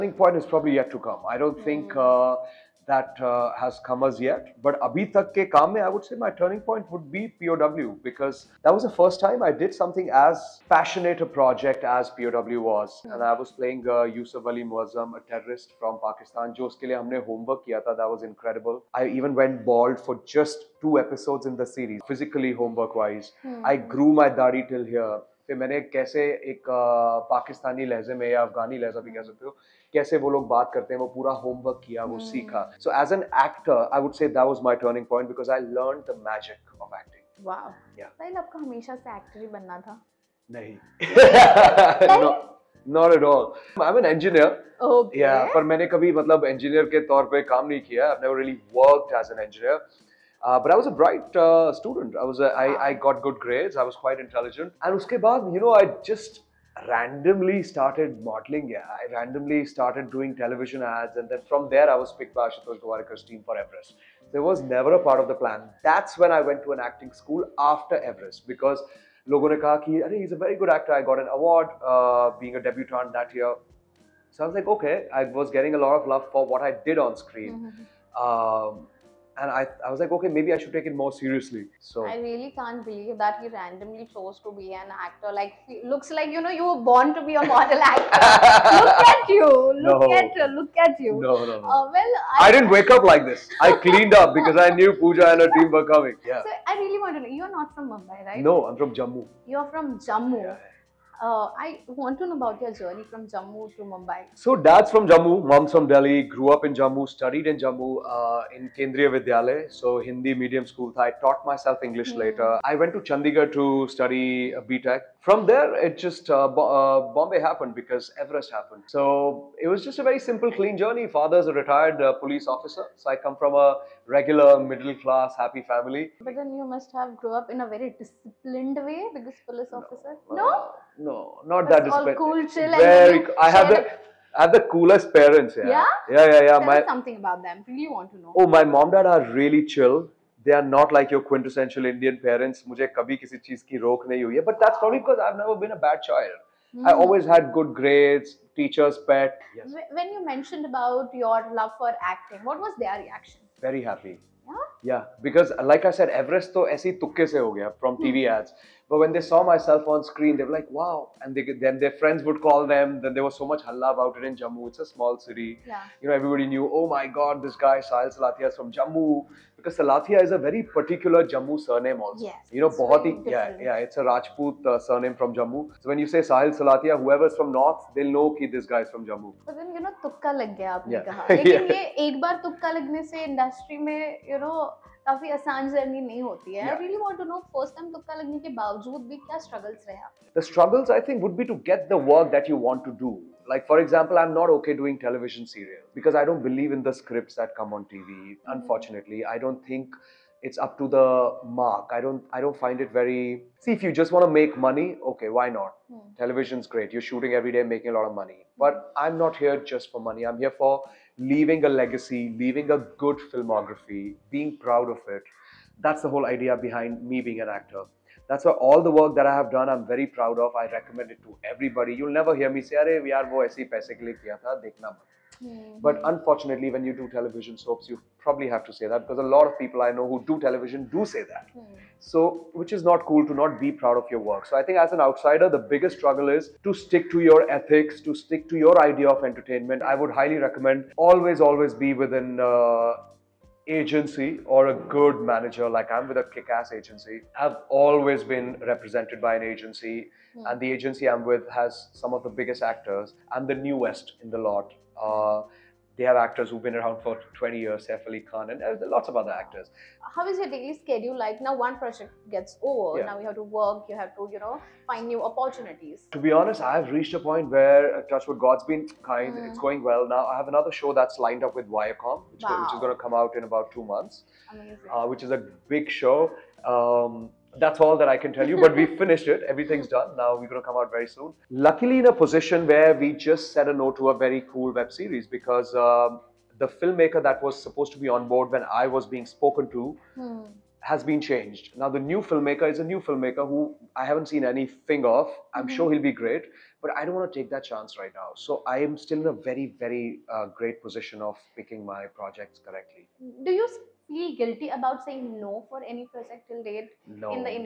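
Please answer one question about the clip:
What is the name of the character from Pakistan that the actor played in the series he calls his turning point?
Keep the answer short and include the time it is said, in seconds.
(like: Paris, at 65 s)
Yusuf Ali Muazzam, at 14 s.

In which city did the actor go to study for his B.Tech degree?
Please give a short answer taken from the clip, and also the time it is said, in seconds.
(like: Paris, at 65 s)
Chandigarh, at 113 s.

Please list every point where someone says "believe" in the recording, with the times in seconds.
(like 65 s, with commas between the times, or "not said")
82 s, 196 s.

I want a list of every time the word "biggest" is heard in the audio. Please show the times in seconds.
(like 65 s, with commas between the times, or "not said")
235 s, 252 s.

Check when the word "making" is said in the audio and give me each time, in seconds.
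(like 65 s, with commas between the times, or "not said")
207 s.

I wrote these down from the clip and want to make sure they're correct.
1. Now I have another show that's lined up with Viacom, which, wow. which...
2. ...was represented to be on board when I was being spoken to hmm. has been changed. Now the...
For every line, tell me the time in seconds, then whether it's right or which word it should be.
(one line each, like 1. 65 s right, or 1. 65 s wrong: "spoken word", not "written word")
1. 270 s right
2. 287 s wrong: "supposed", not "represented".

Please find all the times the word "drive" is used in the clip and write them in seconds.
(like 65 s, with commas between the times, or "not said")
not said.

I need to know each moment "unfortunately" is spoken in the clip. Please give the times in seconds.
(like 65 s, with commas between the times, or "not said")
198 s, 226 s.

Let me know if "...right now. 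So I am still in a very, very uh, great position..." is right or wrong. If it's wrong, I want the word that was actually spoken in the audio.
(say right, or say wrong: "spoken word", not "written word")
right.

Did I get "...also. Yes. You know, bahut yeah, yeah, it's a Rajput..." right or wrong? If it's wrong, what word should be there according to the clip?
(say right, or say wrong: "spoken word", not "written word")
right.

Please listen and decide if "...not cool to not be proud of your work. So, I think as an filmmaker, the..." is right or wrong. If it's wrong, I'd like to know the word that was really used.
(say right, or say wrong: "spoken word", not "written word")
wrong: "outsider", not "filmmaker".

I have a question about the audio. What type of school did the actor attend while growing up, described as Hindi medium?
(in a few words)
Kendriya Vidyalaya.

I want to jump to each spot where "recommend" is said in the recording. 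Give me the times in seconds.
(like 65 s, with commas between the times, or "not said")
220 s, 240 s.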